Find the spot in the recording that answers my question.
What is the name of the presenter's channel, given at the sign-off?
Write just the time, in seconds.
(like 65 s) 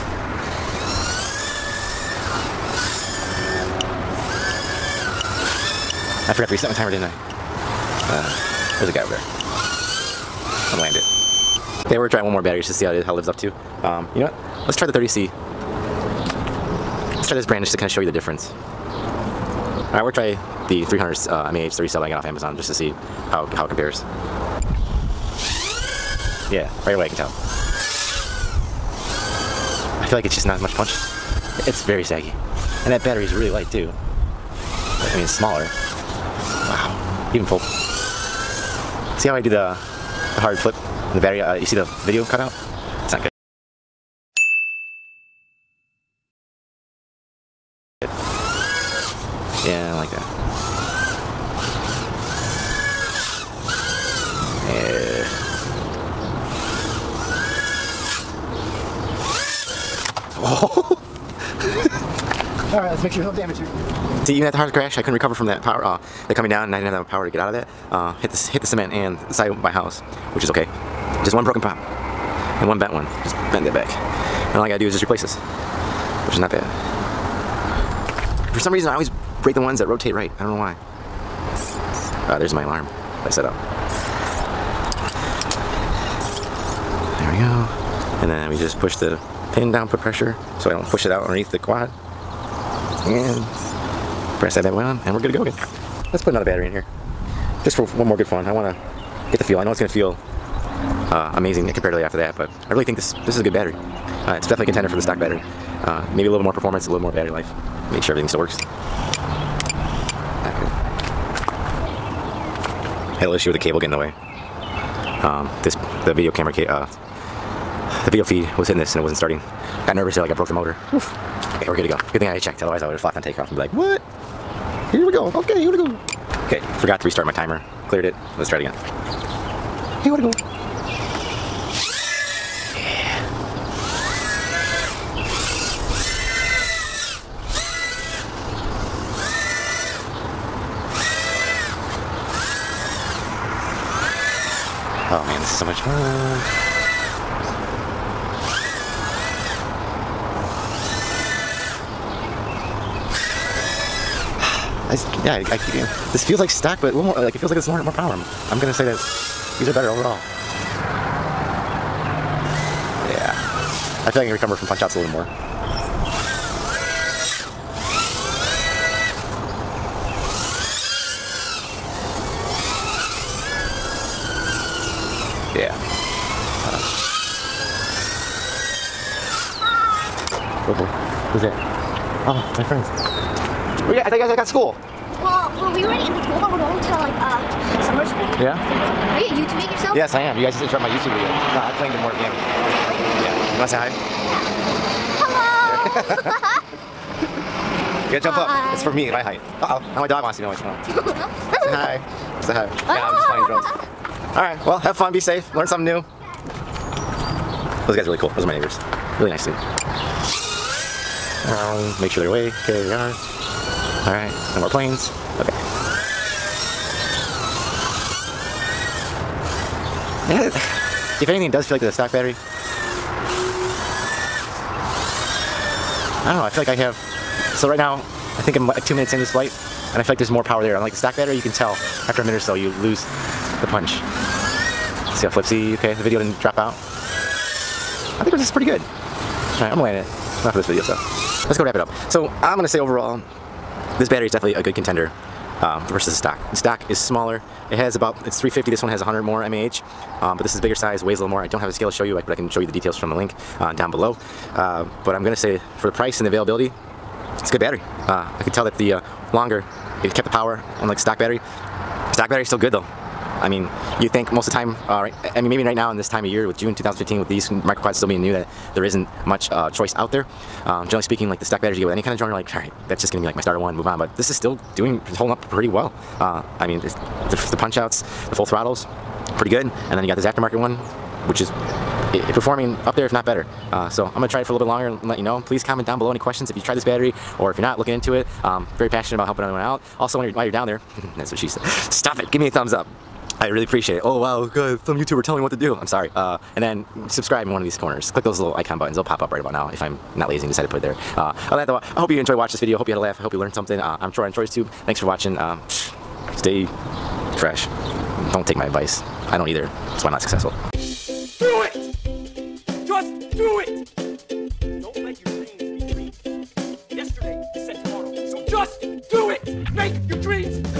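304 s.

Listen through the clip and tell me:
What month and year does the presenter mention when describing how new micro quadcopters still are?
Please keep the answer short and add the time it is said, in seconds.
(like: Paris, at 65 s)
June 2015, at 266 s.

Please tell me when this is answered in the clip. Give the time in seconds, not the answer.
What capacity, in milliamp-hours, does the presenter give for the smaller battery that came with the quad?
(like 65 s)
248 s.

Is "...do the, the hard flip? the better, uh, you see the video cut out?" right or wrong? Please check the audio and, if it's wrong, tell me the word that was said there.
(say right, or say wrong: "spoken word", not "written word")
wrong: "barrier", not "better".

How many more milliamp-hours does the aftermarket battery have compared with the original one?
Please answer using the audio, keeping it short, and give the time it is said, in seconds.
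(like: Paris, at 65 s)
100, at 248 s.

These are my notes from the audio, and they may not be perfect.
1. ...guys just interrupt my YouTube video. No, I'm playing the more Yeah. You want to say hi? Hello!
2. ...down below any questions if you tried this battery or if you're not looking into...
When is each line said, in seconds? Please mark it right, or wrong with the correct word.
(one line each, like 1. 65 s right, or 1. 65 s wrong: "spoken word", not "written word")
1. 190 s right
2. 285 s right.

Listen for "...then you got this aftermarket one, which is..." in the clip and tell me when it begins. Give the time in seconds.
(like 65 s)
279 s.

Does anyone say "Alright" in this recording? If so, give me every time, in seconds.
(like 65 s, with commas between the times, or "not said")
19 s, 204 s, 214 s, 239 s.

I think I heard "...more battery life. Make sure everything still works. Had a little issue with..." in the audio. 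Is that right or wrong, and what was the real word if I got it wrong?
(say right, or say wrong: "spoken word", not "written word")
right.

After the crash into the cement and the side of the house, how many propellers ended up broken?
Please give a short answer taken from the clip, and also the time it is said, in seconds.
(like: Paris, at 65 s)
1, at 71 s.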